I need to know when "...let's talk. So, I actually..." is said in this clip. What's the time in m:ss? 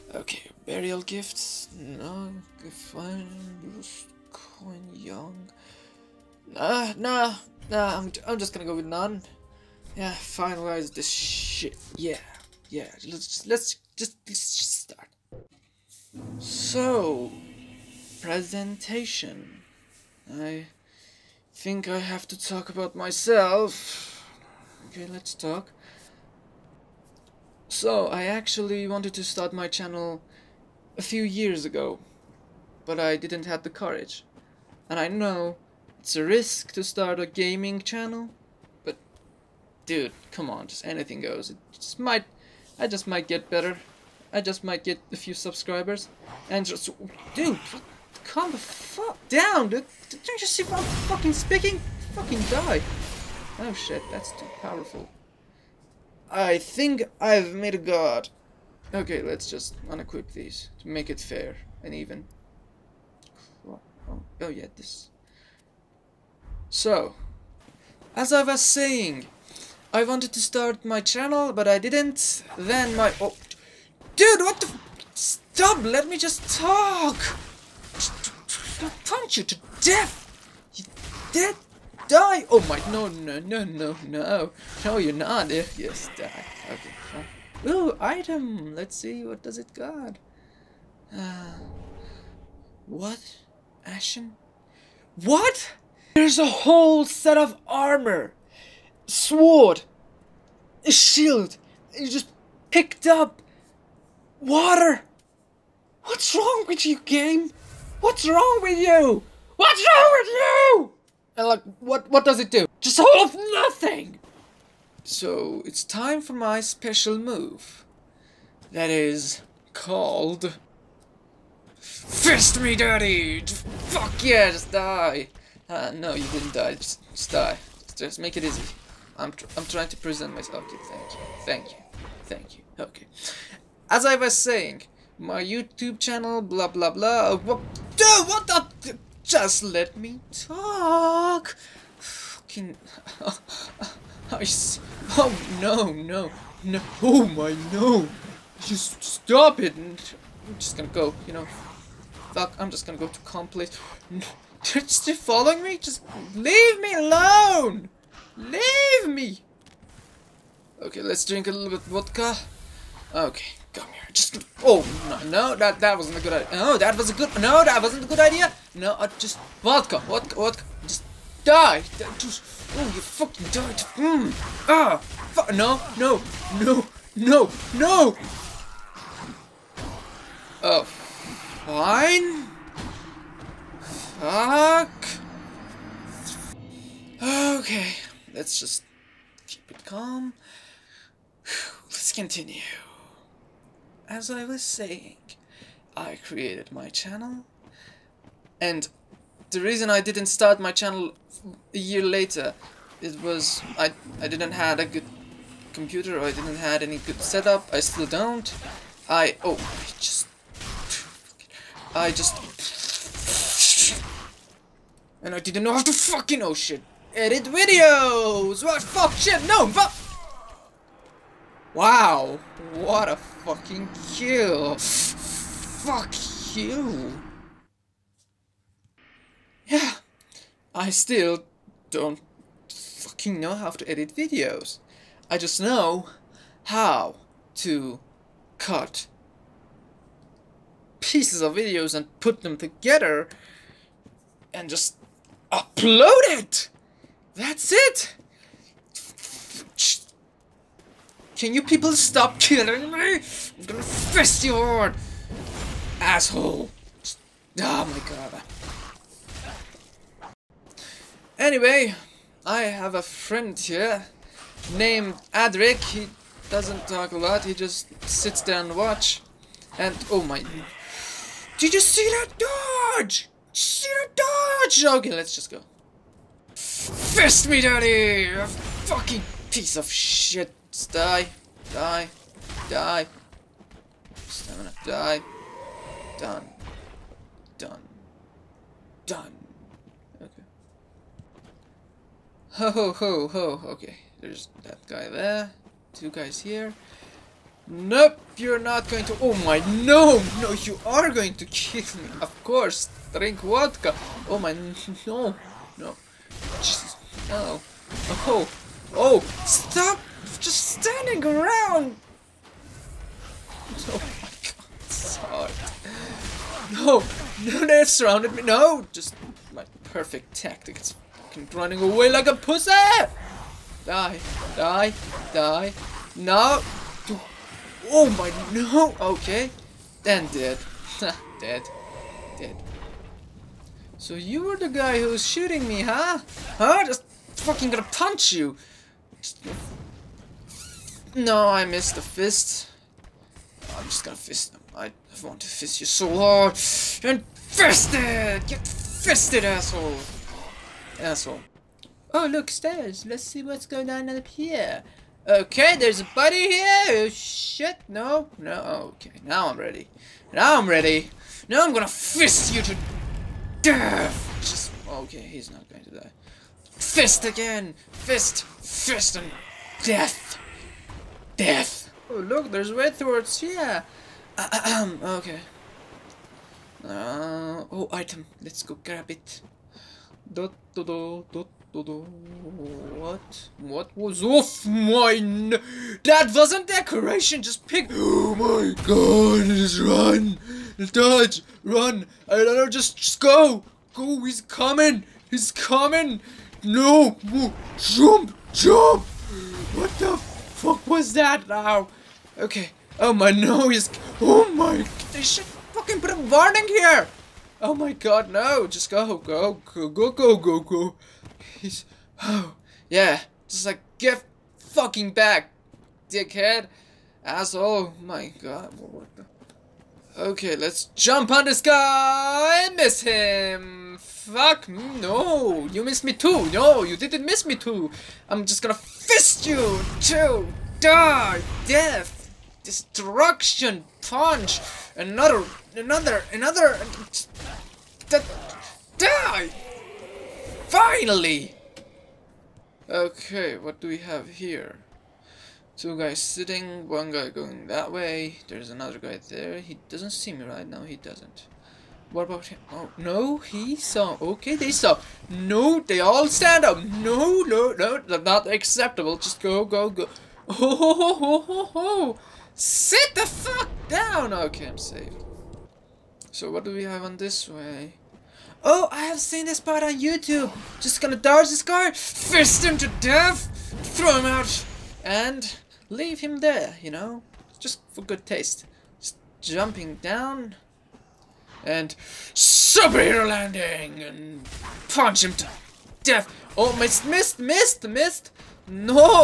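0:25.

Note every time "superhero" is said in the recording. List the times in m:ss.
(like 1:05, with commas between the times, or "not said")
8:02.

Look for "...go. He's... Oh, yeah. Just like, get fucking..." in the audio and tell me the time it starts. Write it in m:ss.
6:50.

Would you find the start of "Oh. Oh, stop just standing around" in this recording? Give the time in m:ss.
5:08.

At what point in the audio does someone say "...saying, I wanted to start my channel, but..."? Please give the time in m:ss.
1:08.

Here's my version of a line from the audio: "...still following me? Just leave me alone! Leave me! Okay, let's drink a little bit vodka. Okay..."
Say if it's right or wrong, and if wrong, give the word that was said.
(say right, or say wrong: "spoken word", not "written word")
right.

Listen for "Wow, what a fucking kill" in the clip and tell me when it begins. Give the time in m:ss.
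3:41.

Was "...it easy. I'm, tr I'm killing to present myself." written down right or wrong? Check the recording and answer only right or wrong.
wrong.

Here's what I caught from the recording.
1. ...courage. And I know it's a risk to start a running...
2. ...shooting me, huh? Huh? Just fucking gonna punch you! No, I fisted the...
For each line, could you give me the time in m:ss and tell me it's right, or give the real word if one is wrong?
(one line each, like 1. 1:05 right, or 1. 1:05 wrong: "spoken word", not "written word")
1. 0:33 wrong: "gaming", not "running"
2. 5:35 wrong: "missed", not "fisted".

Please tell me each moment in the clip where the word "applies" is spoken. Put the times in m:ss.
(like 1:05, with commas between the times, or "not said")
not said.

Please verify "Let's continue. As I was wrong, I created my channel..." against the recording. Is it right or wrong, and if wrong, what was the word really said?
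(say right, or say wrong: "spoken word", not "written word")
wrong: "saying", not "wrong".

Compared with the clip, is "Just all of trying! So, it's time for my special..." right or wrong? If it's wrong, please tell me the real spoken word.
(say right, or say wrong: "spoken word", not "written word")
wrong: "nothing", not "trying".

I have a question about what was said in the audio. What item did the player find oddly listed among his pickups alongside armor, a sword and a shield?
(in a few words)
Water.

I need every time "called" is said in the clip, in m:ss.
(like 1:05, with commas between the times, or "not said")
1:59.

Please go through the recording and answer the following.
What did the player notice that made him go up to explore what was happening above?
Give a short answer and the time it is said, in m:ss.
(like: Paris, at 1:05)
Stairs, at 5:52.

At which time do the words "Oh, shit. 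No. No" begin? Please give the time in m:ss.
5:56.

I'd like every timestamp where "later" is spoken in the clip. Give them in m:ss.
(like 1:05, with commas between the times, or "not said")
3:22.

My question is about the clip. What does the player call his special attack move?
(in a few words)
Fist me dirty.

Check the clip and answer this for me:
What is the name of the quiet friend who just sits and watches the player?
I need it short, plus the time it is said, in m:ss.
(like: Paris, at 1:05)
Adric, at 4:25.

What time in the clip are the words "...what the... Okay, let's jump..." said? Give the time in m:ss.
6:58.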